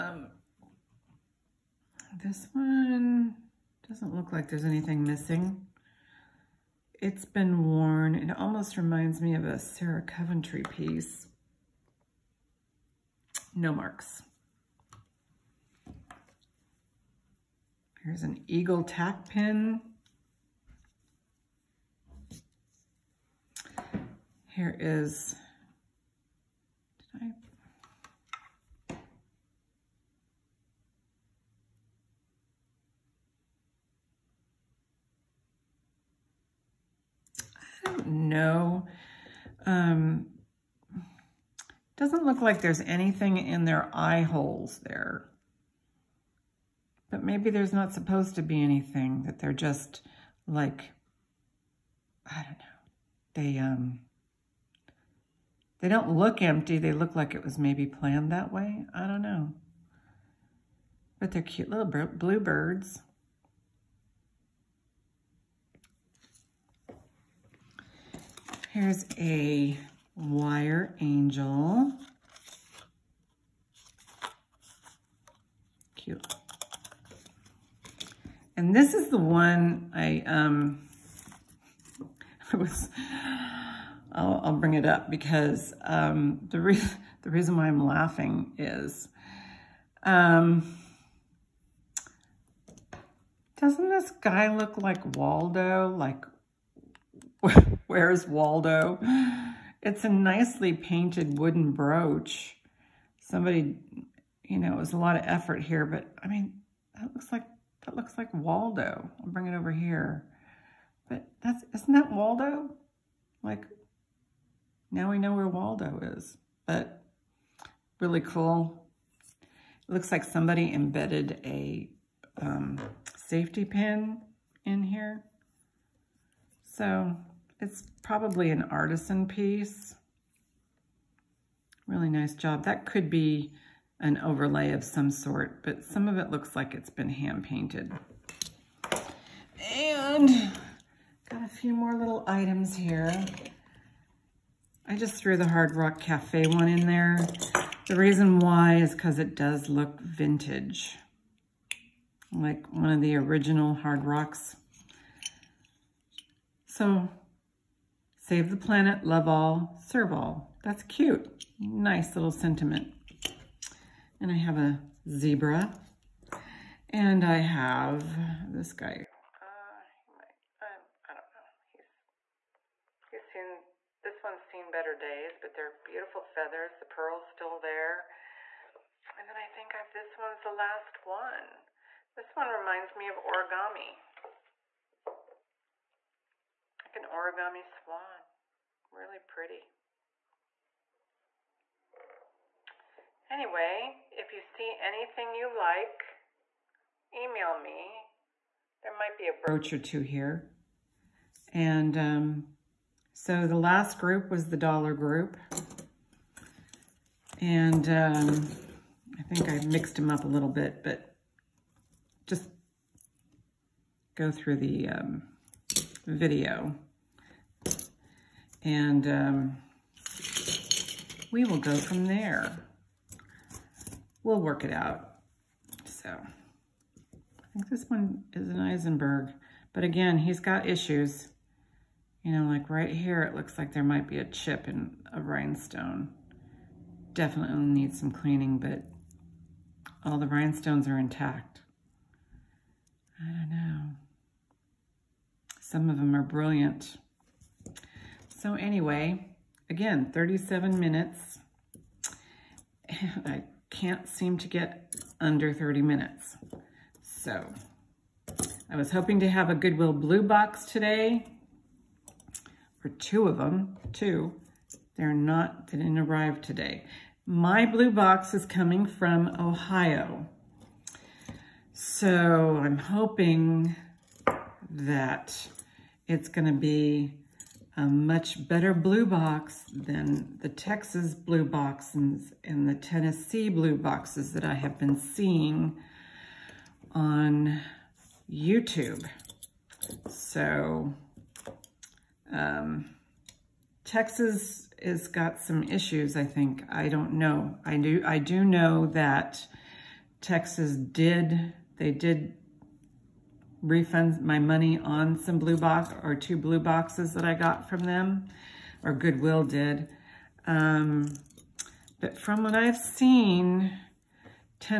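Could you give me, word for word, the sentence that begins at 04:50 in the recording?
So um, Texas has got some issues, I think.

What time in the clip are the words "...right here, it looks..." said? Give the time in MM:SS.
03:52.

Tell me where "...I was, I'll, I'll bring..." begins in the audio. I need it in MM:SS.
01:22.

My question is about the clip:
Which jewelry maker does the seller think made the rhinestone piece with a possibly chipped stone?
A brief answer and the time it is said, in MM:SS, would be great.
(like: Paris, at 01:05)
Eisenberg, at 03:48.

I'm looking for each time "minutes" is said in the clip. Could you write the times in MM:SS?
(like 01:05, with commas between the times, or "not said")
04:10, 04:15.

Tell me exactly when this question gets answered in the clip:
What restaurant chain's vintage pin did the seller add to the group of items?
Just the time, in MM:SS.
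02:25.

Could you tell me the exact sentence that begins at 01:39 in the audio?
It's a nicely painted wooden brooch.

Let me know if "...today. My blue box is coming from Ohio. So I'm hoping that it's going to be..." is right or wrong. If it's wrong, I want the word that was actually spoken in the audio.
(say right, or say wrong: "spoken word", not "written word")
right.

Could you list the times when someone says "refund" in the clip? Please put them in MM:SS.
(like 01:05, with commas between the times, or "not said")
05:03.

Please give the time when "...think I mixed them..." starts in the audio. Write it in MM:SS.
03:29.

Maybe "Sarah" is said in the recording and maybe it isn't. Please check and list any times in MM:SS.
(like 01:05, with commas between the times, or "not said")
00:09.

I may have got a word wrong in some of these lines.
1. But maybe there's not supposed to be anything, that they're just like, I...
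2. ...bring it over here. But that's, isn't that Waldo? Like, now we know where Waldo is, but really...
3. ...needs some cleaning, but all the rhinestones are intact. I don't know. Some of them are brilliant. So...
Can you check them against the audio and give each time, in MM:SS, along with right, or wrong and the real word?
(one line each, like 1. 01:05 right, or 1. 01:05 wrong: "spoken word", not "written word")
1. 00:47 right
2. 01:49 right
3. 03:57 right.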